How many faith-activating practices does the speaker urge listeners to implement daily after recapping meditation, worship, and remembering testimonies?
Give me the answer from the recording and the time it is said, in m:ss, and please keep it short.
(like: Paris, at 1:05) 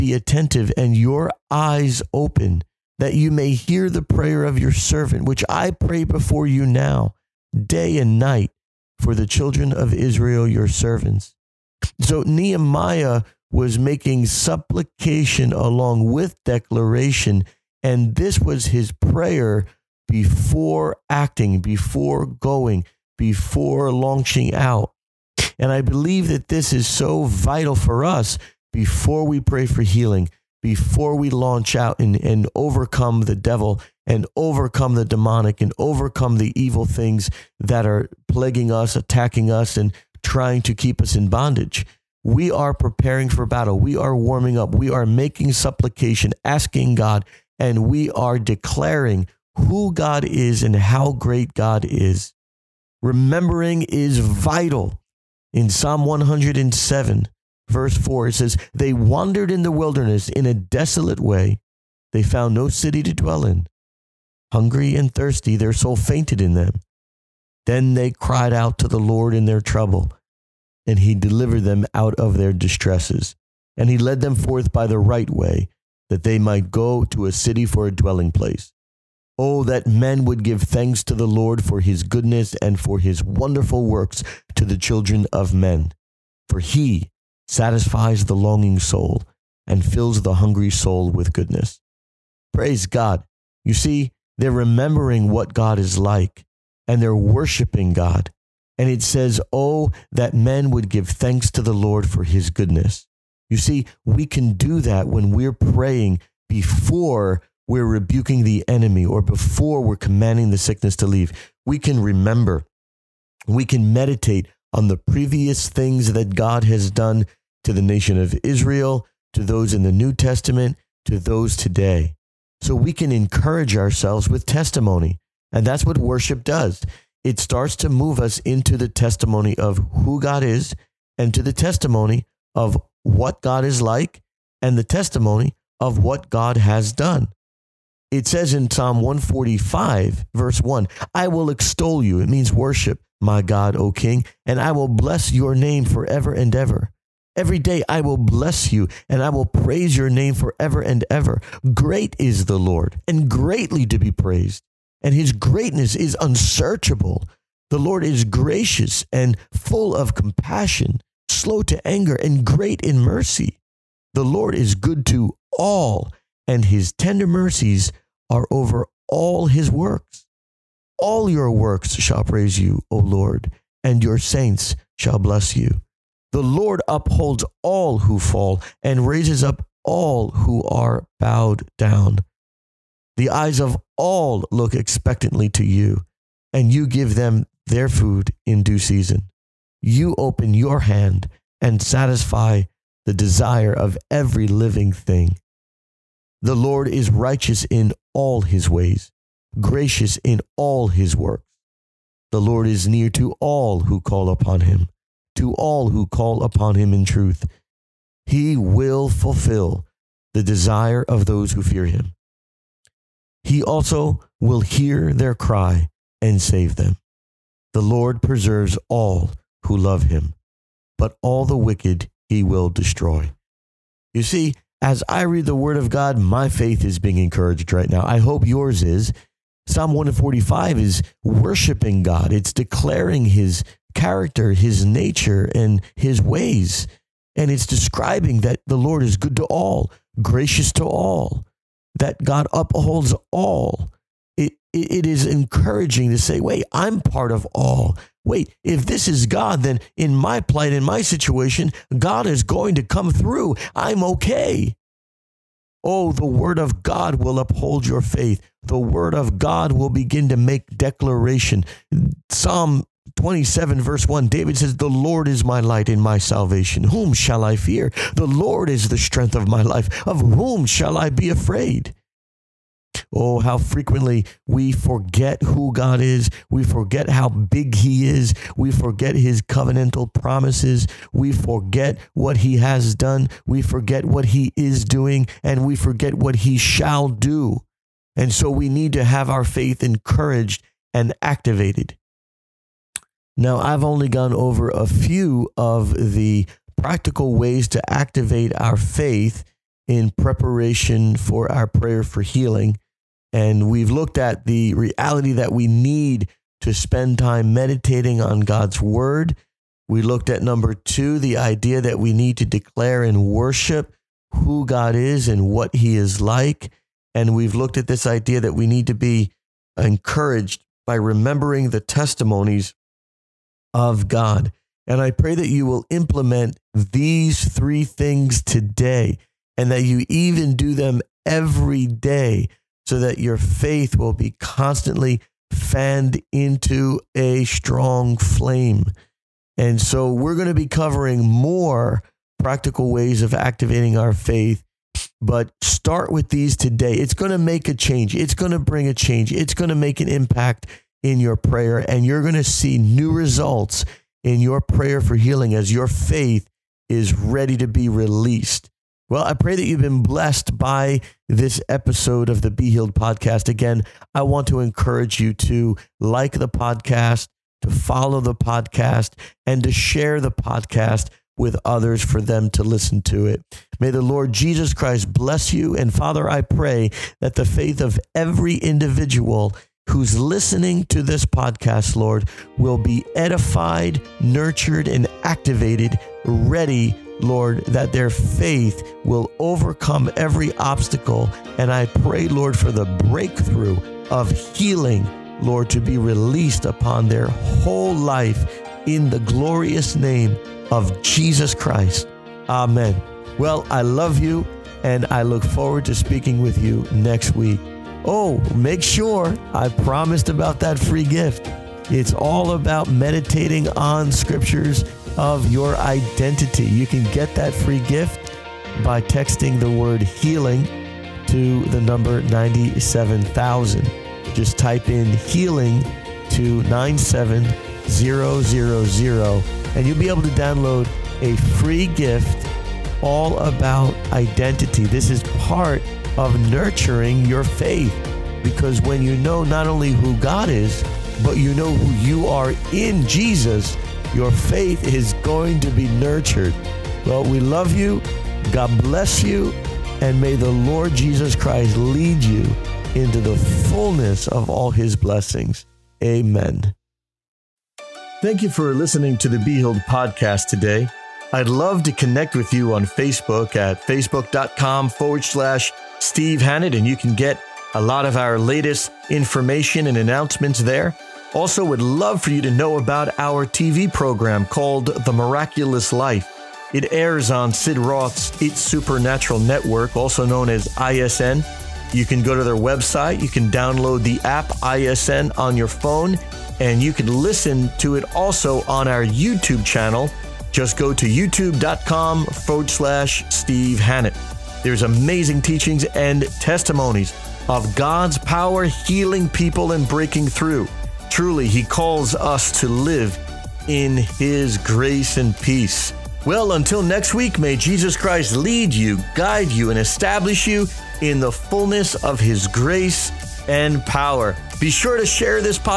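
3, at 5:27.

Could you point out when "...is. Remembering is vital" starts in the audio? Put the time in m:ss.
0:51.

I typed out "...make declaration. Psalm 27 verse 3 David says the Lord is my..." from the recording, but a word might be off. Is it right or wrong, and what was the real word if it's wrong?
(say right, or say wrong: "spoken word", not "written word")
wrong: "1", not "3".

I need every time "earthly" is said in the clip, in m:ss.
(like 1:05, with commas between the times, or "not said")
not said.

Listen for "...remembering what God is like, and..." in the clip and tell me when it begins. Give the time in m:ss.
1:34.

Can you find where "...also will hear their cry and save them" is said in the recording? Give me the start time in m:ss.
3:33.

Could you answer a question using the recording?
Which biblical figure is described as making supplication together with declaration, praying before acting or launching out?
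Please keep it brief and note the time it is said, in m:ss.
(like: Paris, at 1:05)
Nehemiah, at 0:12.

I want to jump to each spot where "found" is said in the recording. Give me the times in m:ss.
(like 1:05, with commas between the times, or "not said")
1:02.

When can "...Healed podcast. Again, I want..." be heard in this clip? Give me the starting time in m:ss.
6:02.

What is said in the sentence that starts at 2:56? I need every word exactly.
The Lord upholds all who fall and raises up all who are bowed down.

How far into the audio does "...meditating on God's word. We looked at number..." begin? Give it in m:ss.
5:07.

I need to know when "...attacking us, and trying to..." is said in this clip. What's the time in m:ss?
0:38.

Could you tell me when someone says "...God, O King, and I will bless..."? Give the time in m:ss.
2:23.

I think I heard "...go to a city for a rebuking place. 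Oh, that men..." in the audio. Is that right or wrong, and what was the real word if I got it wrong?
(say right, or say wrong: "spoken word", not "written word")
wrong: "dwelling", not "rebuking".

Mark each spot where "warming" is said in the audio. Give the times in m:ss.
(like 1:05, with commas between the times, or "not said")
0:44.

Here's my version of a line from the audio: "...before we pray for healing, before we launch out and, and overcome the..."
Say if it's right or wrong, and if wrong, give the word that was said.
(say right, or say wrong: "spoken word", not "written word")
right.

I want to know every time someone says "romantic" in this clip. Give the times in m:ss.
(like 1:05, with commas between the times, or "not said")
not said.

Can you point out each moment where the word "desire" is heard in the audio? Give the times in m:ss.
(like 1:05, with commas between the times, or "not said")
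3:13, 3:30.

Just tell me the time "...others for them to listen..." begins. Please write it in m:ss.
6:11.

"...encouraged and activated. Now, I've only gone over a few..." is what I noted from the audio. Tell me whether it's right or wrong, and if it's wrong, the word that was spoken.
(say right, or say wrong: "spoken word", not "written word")
right.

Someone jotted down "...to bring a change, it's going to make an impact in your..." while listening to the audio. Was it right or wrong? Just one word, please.
right.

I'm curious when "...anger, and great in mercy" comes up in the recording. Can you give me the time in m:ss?
2:41.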